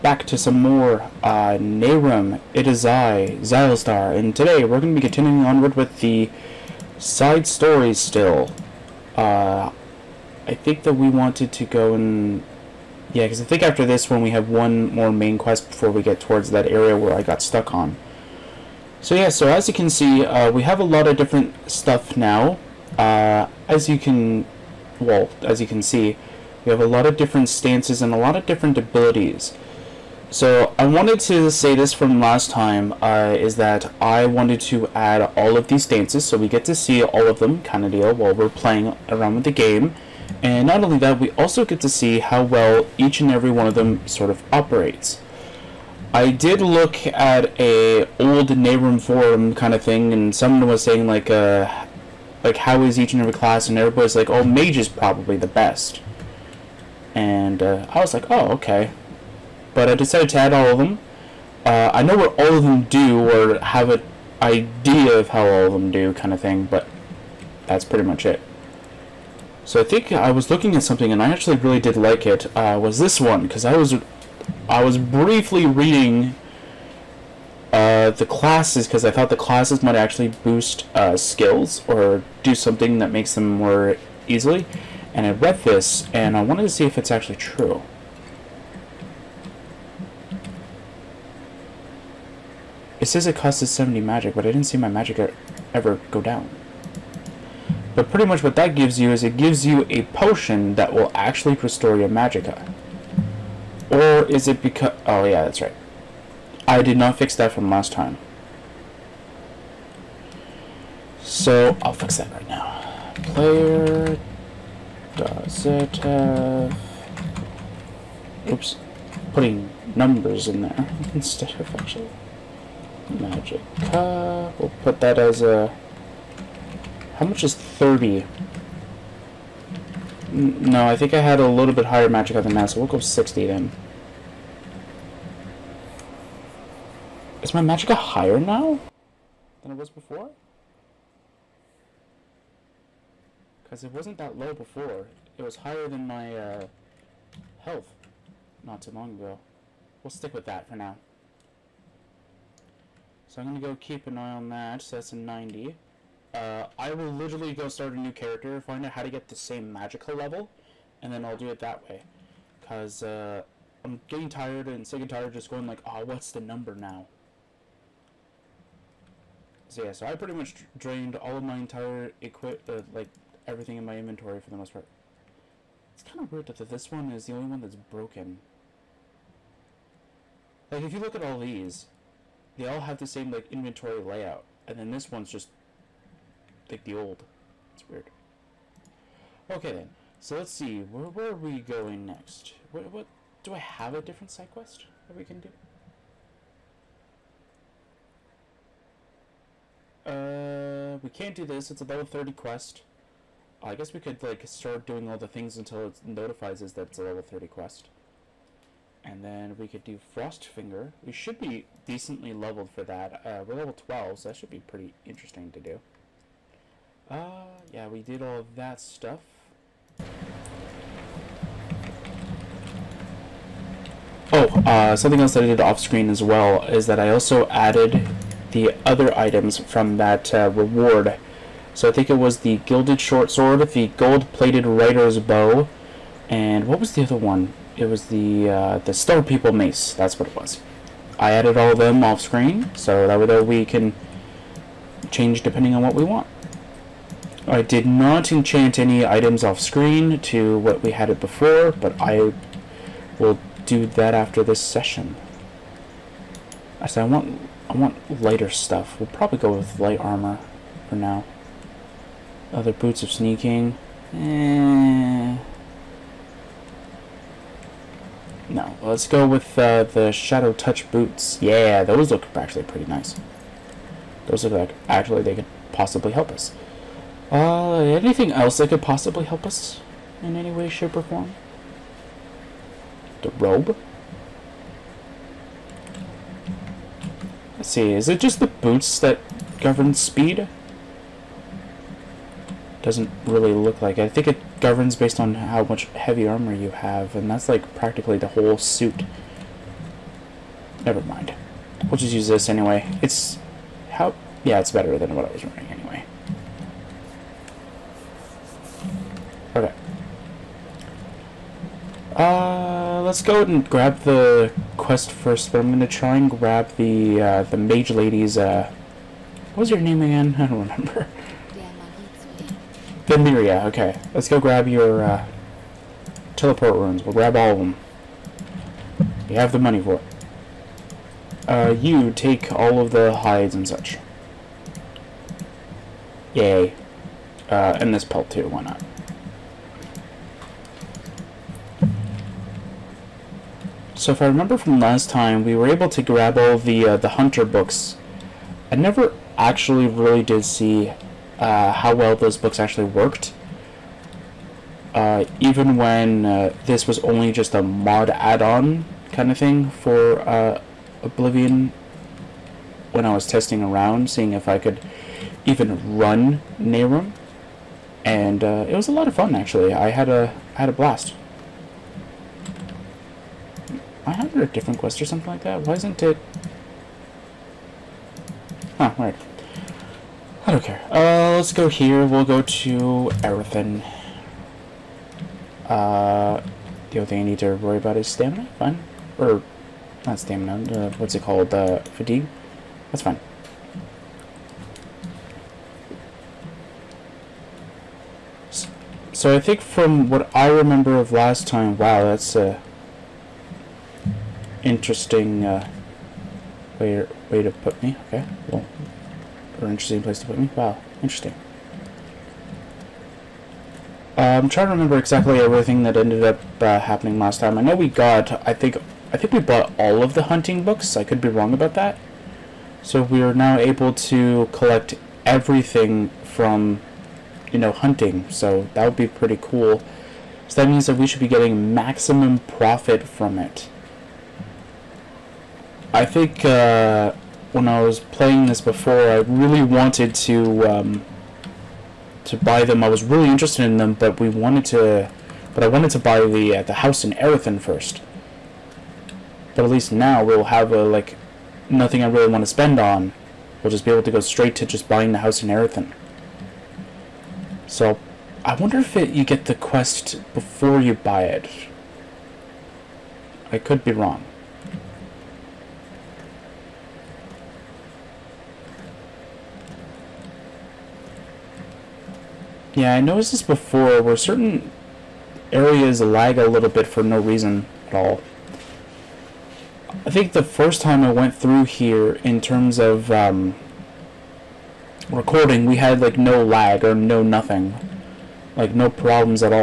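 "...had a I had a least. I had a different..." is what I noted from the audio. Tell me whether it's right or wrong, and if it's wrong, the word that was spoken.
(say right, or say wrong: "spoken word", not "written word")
wrong: "blast", not "least".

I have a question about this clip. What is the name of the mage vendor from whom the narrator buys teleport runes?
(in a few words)
Vendiria.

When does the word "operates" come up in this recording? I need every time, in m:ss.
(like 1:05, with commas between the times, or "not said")
0:44.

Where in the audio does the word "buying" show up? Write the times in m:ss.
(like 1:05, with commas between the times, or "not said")
7:34.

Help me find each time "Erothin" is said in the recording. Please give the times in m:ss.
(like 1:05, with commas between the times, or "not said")
7:27, 7:35.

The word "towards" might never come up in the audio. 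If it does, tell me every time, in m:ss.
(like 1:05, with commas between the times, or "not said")
0:16.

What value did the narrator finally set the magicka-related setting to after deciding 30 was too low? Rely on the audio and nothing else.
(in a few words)
60.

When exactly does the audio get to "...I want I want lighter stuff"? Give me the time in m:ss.
4:17.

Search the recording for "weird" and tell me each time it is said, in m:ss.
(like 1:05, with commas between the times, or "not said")
2:56, 3:07, 6:18.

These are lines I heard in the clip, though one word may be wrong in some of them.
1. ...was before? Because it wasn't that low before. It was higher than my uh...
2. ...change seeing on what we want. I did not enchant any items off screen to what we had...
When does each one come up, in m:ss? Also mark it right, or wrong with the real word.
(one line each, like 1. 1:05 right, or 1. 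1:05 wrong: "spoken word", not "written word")
1. 2:19 right
2. 4:05 wrong: "depending", not "seeing".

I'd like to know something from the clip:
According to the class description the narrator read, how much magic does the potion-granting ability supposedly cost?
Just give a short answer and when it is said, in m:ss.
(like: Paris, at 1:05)
70, at 1:33.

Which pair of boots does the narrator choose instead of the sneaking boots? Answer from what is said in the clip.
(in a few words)
Shadow Touch boots.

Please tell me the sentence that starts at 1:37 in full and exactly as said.
But pretty much what that gives you is it gives you a potion that will actually restore your magicka.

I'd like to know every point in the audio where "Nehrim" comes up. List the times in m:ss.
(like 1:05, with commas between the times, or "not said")
0:01, 0:48, 6:06.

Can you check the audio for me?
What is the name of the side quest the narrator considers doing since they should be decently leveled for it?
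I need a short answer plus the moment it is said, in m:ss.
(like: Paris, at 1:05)
Frost Finger, at 3:29.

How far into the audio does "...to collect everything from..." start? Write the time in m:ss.
7:03.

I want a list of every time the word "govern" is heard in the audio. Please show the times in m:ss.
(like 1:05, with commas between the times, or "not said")
4:49, 4:54.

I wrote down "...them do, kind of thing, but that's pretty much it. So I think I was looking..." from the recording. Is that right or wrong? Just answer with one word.
right.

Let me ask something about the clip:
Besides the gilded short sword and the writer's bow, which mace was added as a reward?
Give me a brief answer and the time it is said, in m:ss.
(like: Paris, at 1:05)
Stone People Mace, at 3:58.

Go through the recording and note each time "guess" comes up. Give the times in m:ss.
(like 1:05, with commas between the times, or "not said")
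3:23.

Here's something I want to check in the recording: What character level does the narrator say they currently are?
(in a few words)
12.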